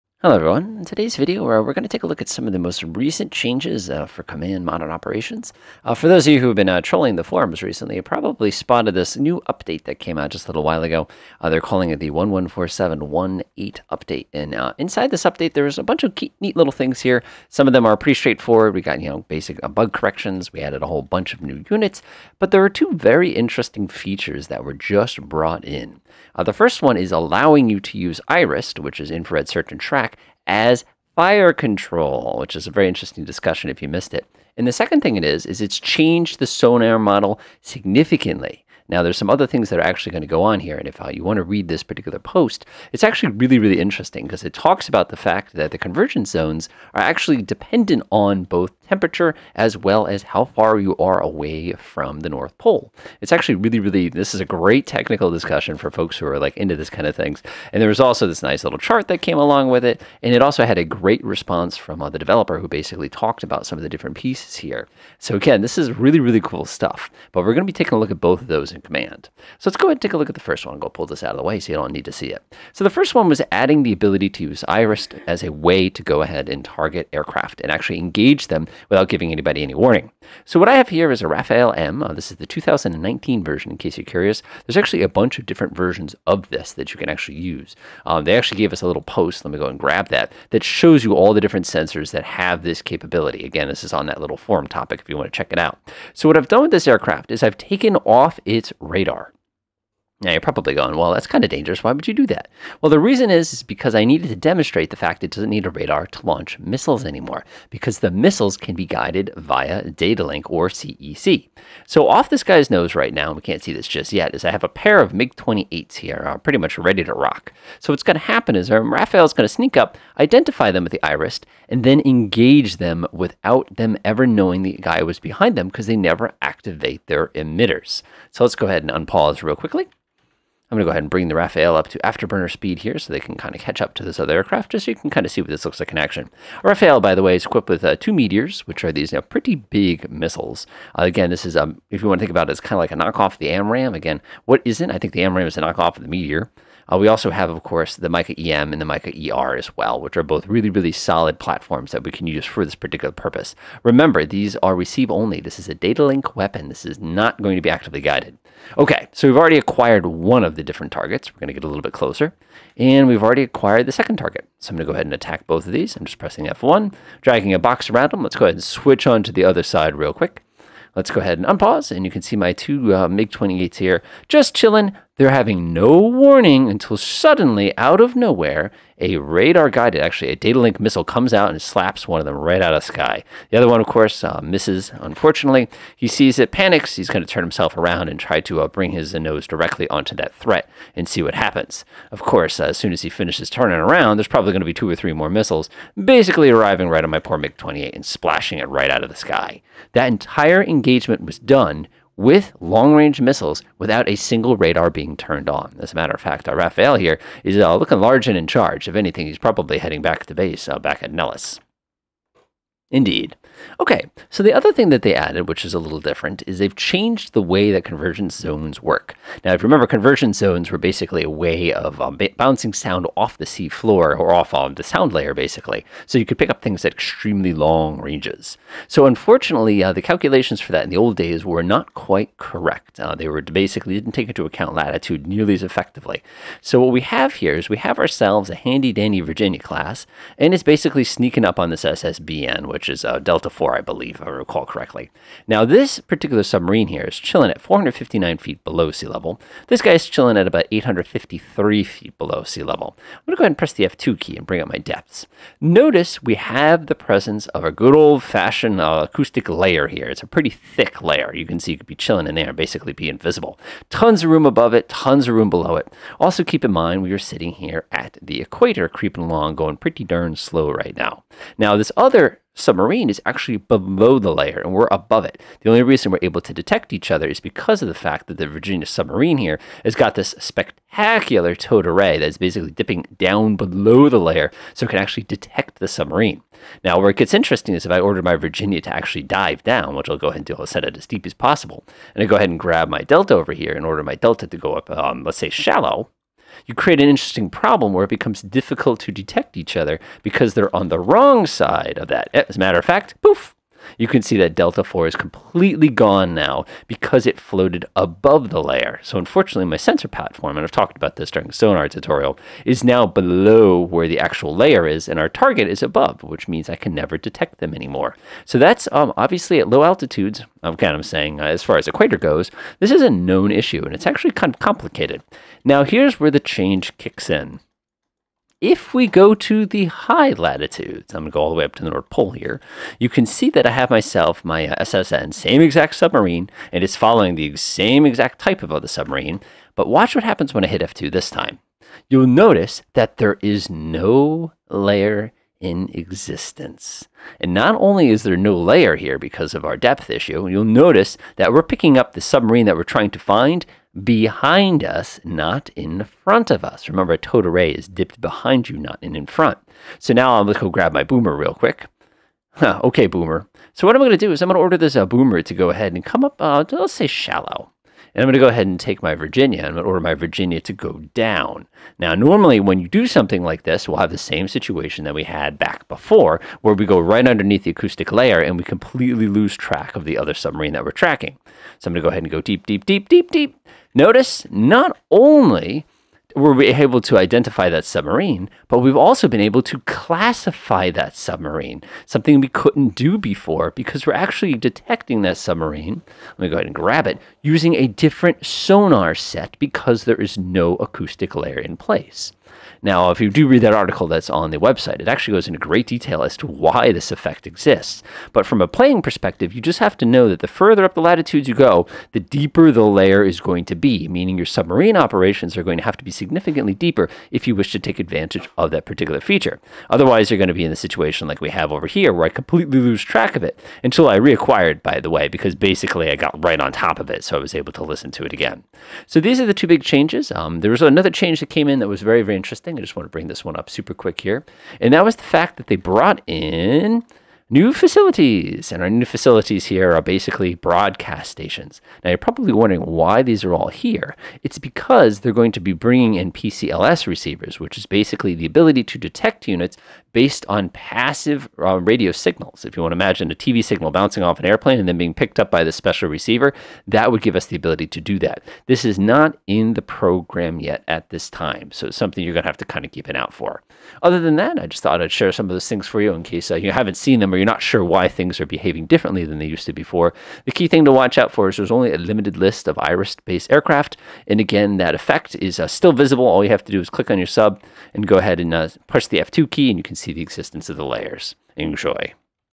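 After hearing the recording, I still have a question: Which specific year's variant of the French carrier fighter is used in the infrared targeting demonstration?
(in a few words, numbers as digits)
2019.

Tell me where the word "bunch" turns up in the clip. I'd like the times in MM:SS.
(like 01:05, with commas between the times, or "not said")
00:15, 00:21, 01:25.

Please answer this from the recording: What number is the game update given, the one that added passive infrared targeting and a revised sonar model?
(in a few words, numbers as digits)
114718.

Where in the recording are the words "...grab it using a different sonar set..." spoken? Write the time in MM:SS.
06:36.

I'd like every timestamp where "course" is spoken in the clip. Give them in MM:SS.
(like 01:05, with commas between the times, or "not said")
02:27, 03:03, 03:12.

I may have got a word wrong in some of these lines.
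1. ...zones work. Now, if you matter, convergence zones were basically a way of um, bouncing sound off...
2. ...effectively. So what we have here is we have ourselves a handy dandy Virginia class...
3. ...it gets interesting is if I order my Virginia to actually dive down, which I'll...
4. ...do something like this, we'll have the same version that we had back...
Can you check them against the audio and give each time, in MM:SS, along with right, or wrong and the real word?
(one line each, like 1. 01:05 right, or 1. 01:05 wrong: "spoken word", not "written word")
1. 03:38 wrong: "remember", not "matter"
2. 03:55 right
3. 04:47 right
4. 06:12 wrong: "situation", not "version".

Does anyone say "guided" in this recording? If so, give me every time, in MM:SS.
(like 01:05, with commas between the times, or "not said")
01:48, 02:38, 02:59.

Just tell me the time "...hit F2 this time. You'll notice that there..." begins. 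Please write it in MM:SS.
05:40.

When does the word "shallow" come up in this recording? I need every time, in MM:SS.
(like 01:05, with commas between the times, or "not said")
04:55, 06:07.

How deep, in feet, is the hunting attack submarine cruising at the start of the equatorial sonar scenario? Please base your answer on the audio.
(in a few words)
459 feet.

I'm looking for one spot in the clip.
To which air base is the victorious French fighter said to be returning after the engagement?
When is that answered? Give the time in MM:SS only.
03:31.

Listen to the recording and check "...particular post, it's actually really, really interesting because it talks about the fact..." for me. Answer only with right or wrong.
right.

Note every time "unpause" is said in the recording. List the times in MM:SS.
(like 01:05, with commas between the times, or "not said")
02:08, 02:51.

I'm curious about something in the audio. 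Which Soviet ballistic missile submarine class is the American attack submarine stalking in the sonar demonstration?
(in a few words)
Delta IV.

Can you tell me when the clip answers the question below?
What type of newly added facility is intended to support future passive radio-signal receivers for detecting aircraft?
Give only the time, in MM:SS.
07:20.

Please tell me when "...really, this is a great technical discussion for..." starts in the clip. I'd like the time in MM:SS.
00:53.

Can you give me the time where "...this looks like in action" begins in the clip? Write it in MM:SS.
02:15.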